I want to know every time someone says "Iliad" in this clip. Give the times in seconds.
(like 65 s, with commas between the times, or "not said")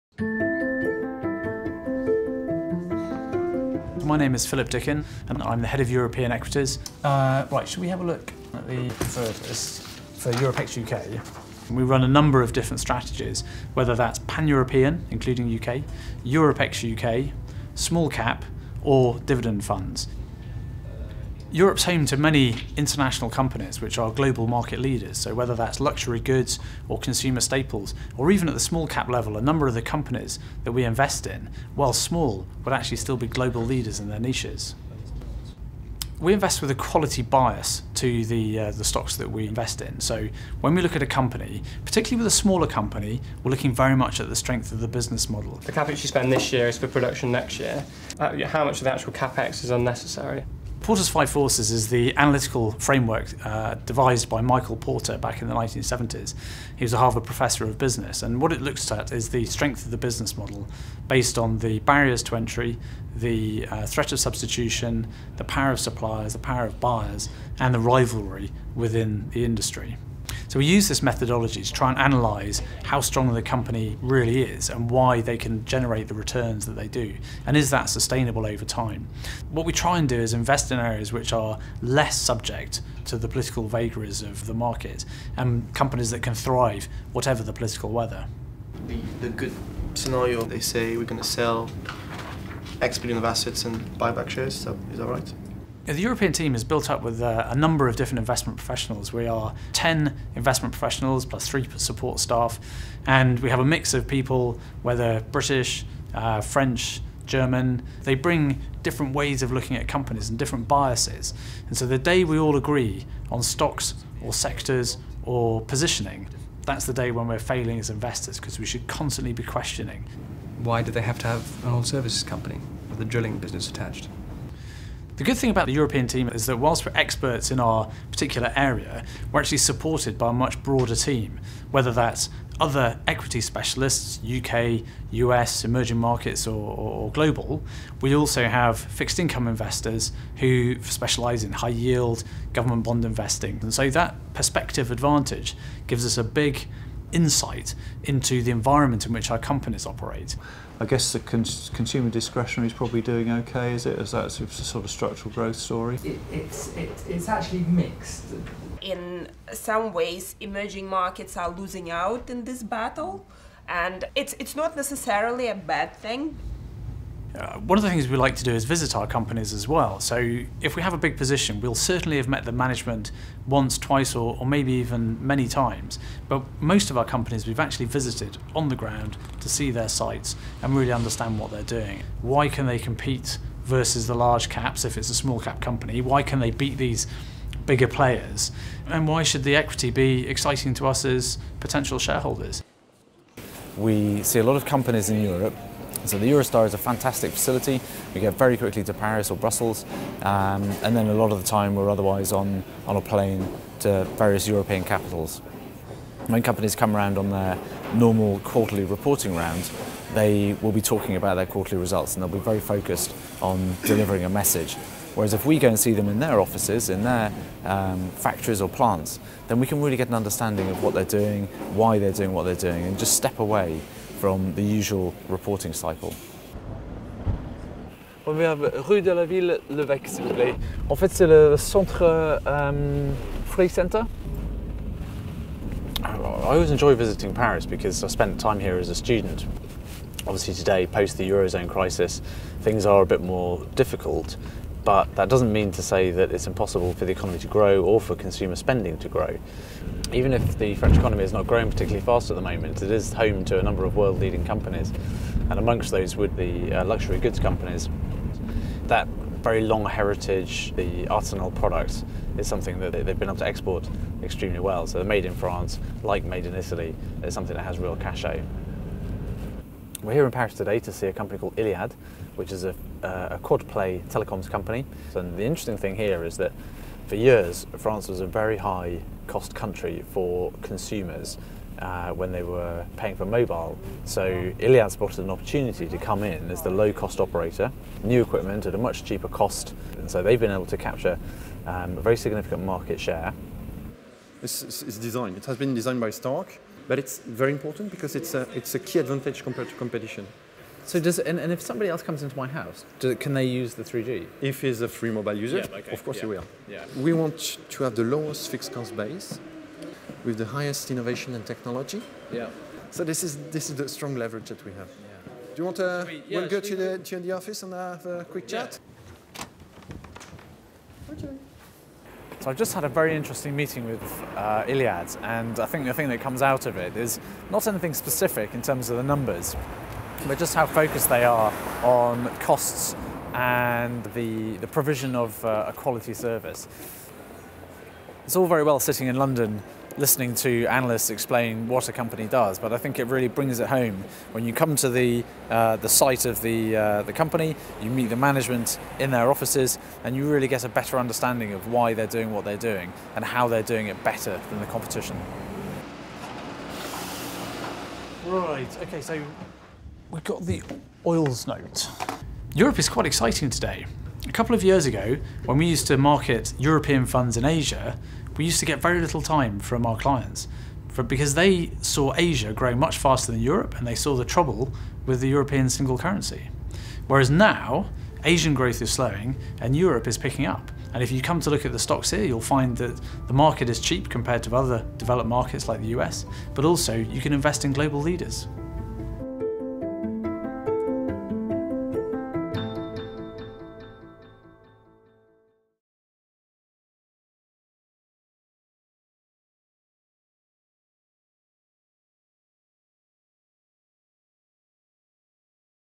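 271 s, 284 s, 324 s.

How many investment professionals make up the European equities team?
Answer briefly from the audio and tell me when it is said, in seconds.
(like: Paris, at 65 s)
10, at 99 s.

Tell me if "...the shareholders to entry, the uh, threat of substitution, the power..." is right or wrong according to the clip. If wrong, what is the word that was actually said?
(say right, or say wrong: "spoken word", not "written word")
wrong: "barriers", not "shareholders".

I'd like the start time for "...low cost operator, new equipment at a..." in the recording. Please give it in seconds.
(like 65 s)
286 s.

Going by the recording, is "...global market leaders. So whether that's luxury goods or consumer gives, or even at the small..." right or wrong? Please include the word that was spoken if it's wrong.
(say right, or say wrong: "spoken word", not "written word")
wrong: "staples", not "gives".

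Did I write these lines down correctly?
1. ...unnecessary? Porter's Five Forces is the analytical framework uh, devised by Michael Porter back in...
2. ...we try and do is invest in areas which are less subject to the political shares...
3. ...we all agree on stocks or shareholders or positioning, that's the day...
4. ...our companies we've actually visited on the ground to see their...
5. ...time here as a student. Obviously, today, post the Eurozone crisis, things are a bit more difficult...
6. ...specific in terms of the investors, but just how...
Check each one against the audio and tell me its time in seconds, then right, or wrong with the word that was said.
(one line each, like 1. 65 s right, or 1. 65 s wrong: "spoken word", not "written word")
1. 49 s right
2. 79 s wrong: "vagaries", not "shares"
3. 112 s wrong: "sectors", not "shareholders"
4. 176 s right
5. 238 s right
6. 327 s wrong: "numbers", not "investors".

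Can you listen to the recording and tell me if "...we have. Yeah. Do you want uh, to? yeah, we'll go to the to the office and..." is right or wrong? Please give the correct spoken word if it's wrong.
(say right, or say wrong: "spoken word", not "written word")
right.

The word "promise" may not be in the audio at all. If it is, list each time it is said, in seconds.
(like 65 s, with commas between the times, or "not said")
not said.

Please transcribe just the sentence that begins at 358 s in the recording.
Right, okay, so we've got the oils note.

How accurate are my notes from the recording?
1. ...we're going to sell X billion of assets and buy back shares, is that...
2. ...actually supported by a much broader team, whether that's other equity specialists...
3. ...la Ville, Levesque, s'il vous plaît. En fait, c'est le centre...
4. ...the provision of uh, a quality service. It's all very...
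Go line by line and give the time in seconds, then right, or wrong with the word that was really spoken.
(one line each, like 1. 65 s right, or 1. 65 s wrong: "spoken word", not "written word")
1. 90 s right
2. 129 s right
3. 229 s right
4. 334 s right.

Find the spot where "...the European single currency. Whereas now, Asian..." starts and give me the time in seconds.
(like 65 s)
375 s.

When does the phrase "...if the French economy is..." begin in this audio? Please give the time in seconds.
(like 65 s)
250 s.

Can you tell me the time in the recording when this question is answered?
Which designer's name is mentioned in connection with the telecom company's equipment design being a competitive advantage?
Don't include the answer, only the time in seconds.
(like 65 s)
296 s.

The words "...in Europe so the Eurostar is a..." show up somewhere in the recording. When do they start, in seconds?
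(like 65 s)
195 s.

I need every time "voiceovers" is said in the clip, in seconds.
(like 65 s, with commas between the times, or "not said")
not said.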